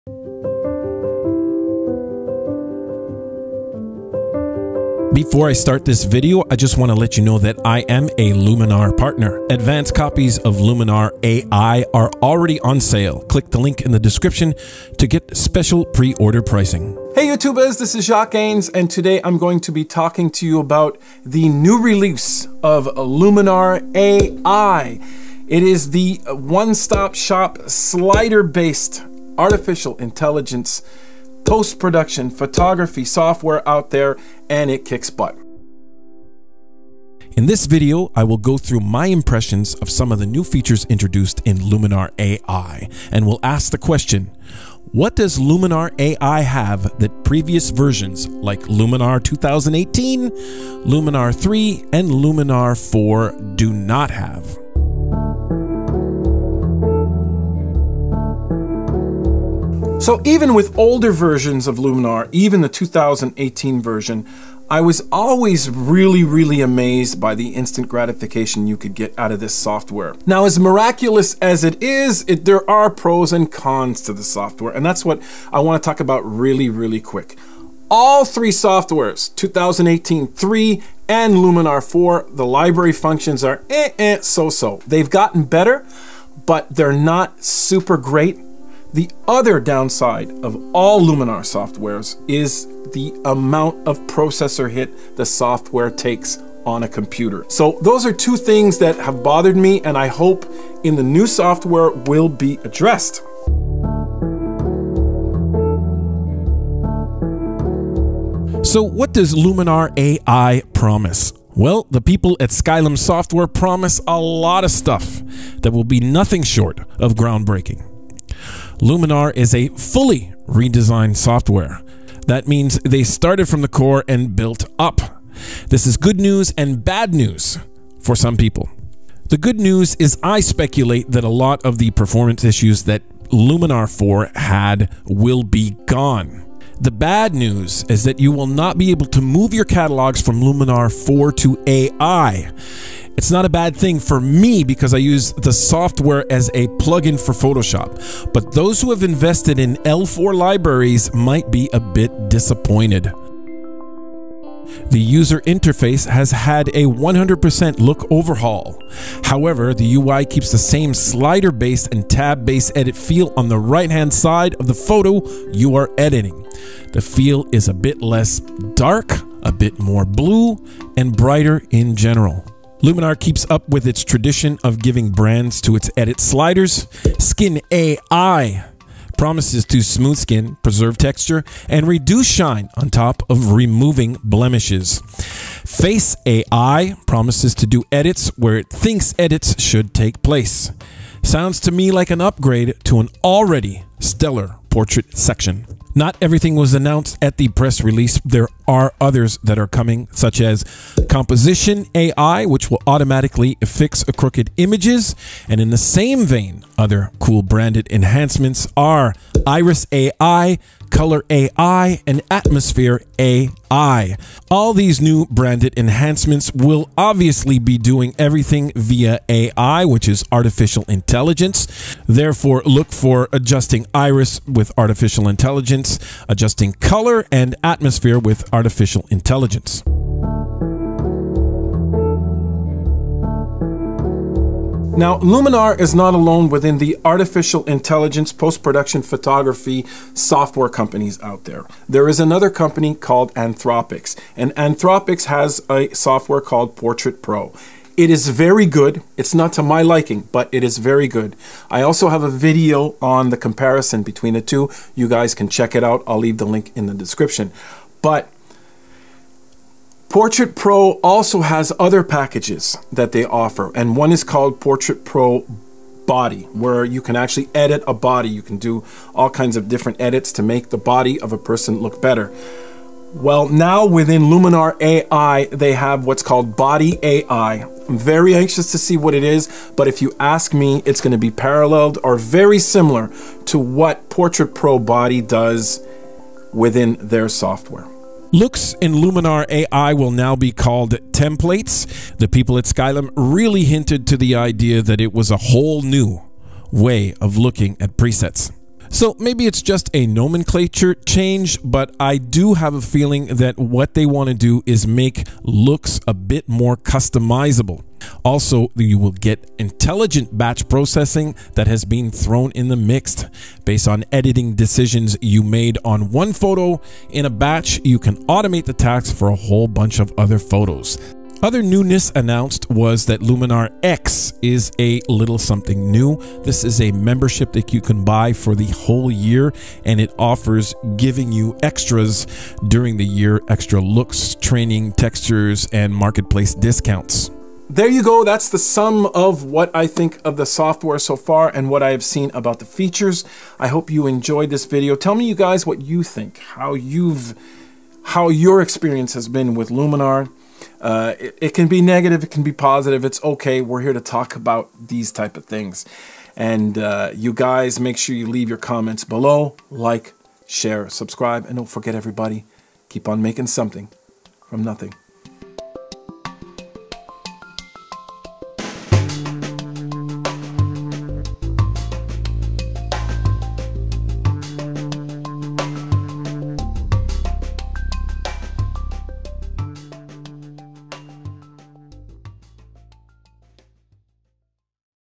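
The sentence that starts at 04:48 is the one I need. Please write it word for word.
Looks in Luminar AI will now be called templates.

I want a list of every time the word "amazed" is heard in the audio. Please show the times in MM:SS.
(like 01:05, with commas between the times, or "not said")
01:06.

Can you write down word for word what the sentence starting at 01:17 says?
All three softwares, 2018 3 and Luminar 4, the library functions are eh, eh, so-so.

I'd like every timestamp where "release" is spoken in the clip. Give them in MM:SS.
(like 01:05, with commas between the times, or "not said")
00:21, 03:17.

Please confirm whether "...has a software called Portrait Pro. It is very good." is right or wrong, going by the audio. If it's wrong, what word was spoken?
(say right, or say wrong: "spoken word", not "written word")
right.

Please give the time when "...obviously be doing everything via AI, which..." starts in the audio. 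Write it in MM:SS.
03:36.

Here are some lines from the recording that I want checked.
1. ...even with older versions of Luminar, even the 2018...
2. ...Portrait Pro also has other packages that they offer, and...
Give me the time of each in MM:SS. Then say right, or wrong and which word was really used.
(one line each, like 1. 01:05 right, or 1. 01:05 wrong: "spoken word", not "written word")
1. 01:00 right
2. 04:20 right.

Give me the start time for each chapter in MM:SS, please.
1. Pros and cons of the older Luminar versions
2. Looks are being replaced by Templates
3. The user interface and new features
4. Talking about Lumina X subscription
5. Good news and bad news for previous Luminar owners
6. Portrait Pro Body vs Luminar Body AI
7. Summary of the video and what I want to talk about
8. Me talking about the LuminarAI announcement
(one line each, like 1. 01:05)
1. 00:55
2. 04:48
3. 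02:33
4. 05:13
5. 01:44
6. 03:50
7. 00:35
8. 00:17.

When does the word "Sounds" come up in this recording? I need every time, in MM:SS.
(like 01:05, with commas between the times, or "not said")
03:11.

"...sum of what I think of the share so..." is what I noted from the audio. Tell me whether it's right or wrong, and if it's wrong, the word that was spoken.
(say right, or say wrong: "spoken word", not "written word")
wrong: "software", not "share".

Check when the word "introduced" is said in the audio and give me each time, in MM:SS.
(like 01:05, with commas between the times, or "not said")
00:40.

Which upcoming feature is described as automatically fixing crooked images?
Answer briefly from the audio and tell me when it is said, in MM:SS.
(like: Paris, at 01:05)
Composition AI, at 03:21.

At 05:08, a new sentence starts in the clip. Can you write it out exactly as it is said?
Also, you will get intelligent batch processing that has been thrown in the mix.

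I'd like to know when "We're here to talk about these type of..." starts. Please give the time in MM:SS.
05:53.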